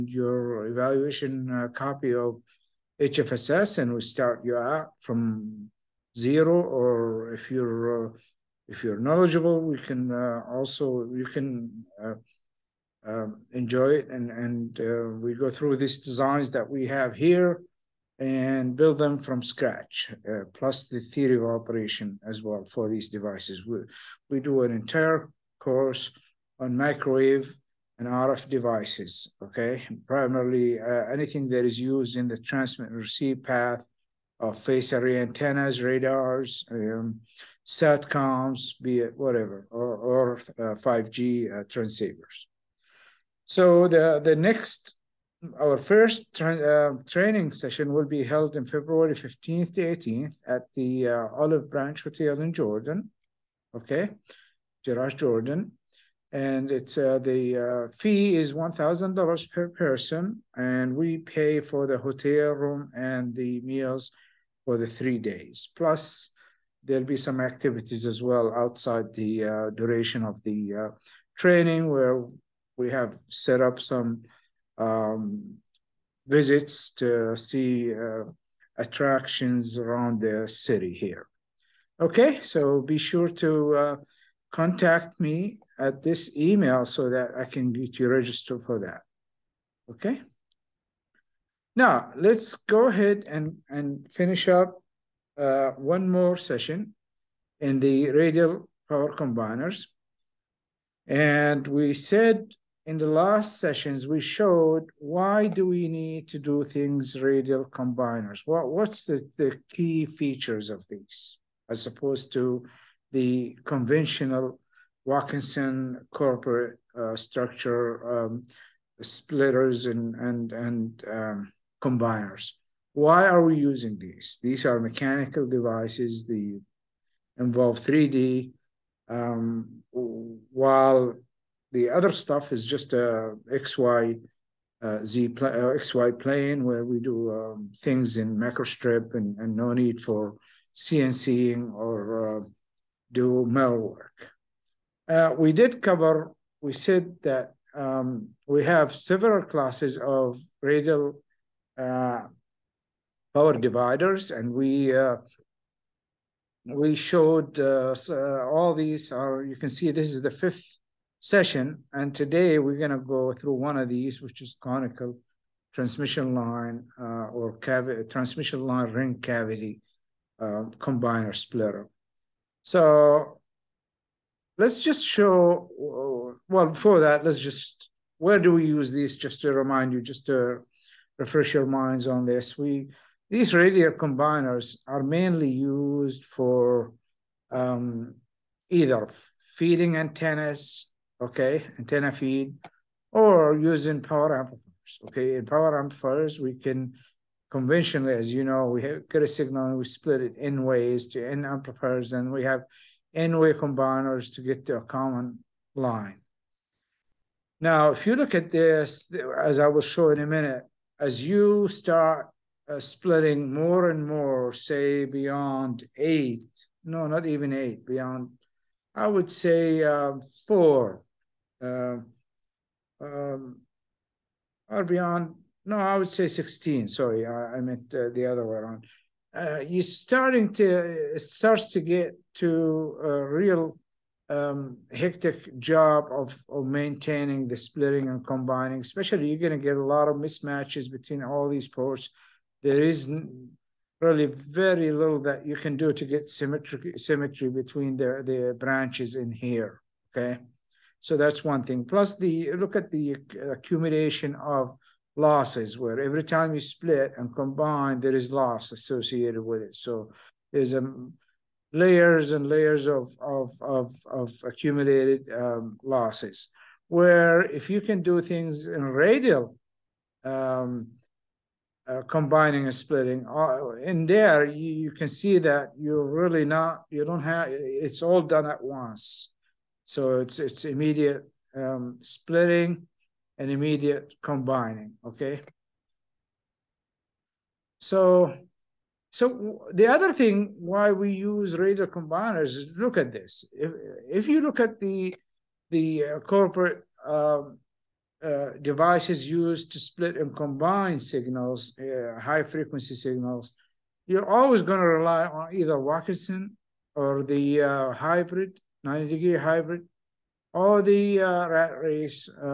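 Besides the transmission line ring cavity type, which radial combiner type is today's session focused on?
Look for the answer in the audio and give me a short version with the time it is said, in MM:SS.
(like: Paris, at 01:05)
Conical transmission line, at 02:44.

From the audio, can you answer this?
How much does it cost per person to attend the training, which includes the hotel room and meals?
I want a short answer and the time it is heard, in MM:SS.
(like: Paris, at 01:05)
$1,000, at 00:58.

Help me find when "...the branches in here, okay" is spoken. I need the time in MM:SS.
04:08.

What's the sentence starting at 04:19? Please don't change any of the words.
So there's um, layers and layers of of of, of accumulated um, losses.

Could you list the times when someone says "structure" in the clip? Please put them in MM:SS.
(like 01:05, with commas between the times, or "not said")
01:57.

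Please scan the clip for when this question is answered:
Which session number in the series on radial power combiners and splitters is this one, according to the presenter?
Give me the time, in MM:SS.
02:40.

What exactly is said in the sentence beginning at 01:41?
And we said in the last sessions, we showed why do we need to do things radial combiners?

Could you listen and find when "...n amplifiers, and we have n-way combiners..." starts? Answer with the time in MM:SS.
03:21.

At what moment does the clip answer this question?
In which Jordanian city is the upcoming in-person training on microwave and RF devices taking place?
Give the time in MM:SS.
00:54.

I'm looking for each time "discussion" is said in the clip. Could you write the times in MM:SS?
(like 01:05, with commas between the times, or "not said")
not said.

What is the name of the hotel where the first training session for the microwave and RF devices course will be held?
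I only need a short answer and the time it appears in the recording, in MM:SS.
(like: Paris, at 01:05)
Olive Branch Hotel, at 00:51.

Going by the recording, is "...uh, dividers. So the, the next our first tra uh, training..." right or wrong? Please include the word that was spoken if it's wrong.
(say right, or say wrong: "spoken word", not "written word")
wrong: "transceivers", not "dividers".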